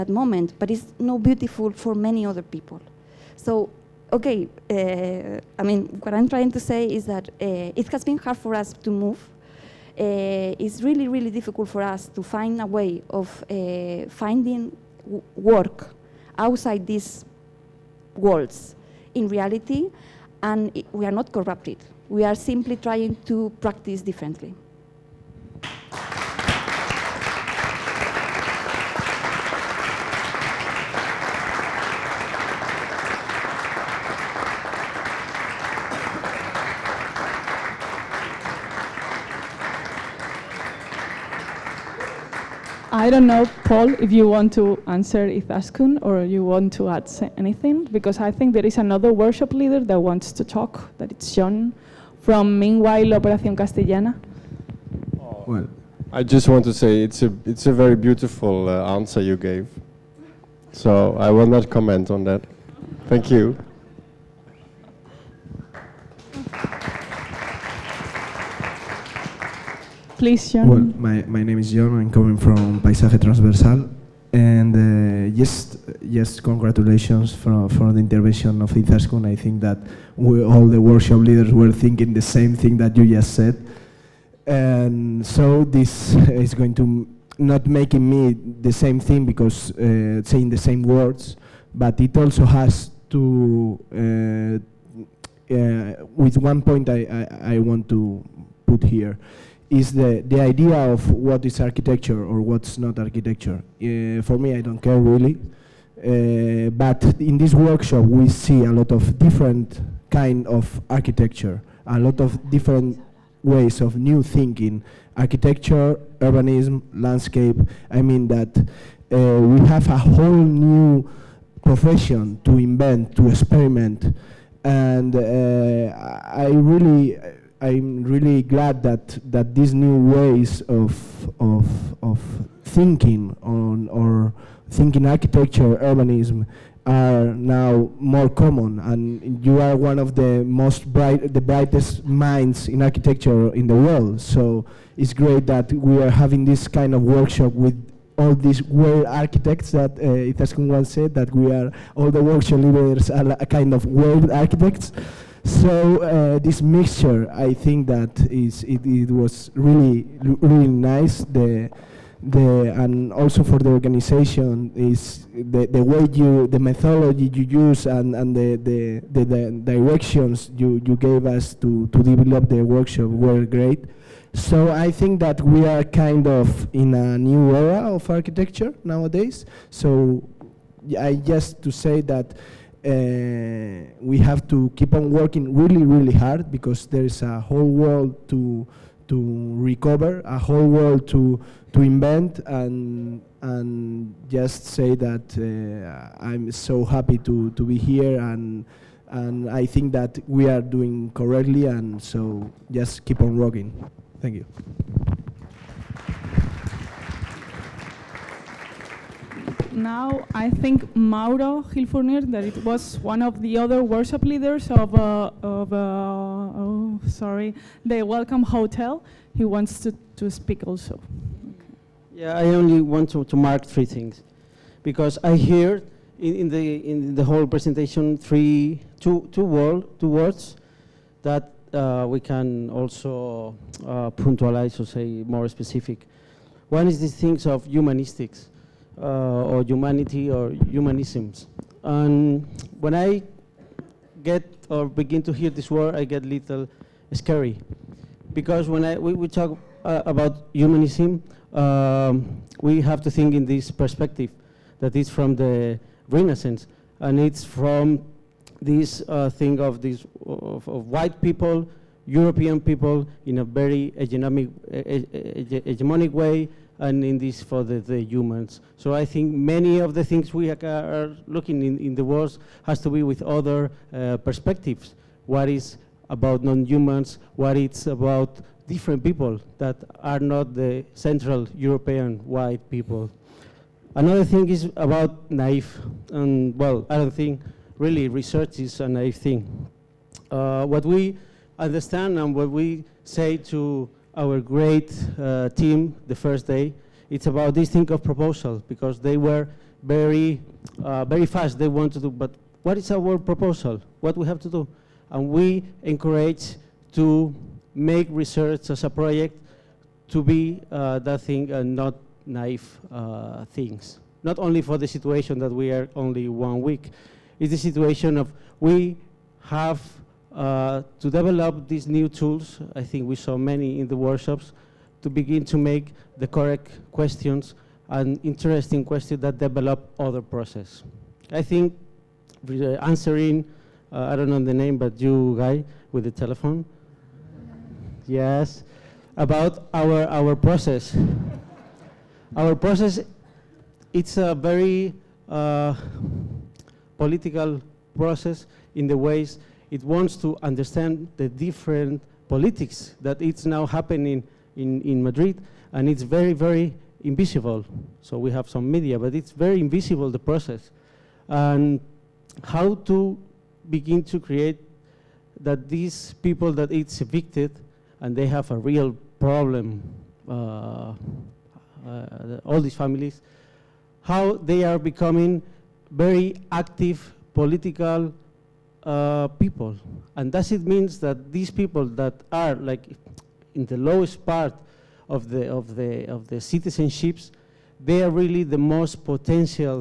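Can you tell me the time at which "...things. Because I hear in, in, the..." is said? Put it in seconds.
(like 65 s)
223 s.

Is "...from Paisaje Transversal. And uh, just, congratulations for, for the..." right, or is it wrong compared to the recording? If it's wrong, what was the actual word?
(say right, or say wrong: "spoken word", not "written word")
right.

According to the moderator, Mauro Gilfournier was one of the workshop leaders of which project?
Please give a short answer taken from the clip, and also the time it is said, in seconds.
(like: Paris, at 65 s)
the Welcome Hotel, at 217 s.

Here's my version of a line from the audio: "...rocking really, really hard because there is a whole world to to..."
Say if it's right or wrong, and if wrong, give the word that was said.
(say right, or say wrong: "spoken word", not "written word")
wrong: "working", not "rocking".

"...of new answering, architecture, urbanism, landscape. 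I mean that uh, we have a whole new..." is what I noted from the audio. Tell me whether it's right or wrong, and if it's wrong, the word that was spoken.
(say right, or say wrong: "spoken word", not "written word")
wrong: "thinking", not "answering".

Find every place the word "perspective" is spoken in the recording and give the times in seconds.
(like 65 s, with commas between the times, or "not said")
253 s, 274 s.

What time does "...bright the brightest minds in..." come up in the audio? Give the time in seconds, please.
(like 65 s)
140 s.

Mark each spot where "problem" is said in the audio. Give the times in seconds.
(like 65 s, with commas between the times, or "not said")
369 s.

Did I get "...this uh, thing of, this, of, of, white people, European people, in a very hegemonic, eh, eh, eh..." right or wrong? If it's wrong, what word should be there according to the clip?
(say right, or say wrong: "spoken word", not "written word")
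right.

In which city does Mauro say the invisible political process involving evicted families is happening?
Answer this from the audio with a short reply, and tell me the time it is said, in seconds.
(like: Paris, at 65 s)
Madrid, at 355 s.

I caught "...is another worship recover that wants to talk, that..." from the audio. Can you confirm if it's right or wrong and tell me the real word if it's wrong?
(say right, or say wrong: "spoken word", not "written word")
wrong: "leader", not "recover".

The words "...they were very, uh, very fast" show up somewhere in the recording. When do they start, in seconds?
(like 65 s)
298 s.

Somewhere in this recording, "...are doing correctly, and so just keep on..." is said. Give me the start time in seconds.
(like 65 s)
200 s.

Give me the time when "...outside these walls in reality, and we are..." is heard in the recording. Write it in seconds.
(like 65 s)
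16 s.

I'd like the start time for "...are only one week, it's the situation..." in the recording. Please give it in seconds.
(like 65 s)
315 s.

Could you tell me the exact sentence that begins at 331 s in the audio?
I think answering, uh, I don't know the name, but you guy with the telephone, yes, about our, our process.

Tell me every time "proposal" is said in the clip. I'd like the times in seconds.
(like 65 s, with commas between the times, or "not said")
298 s, 303 s.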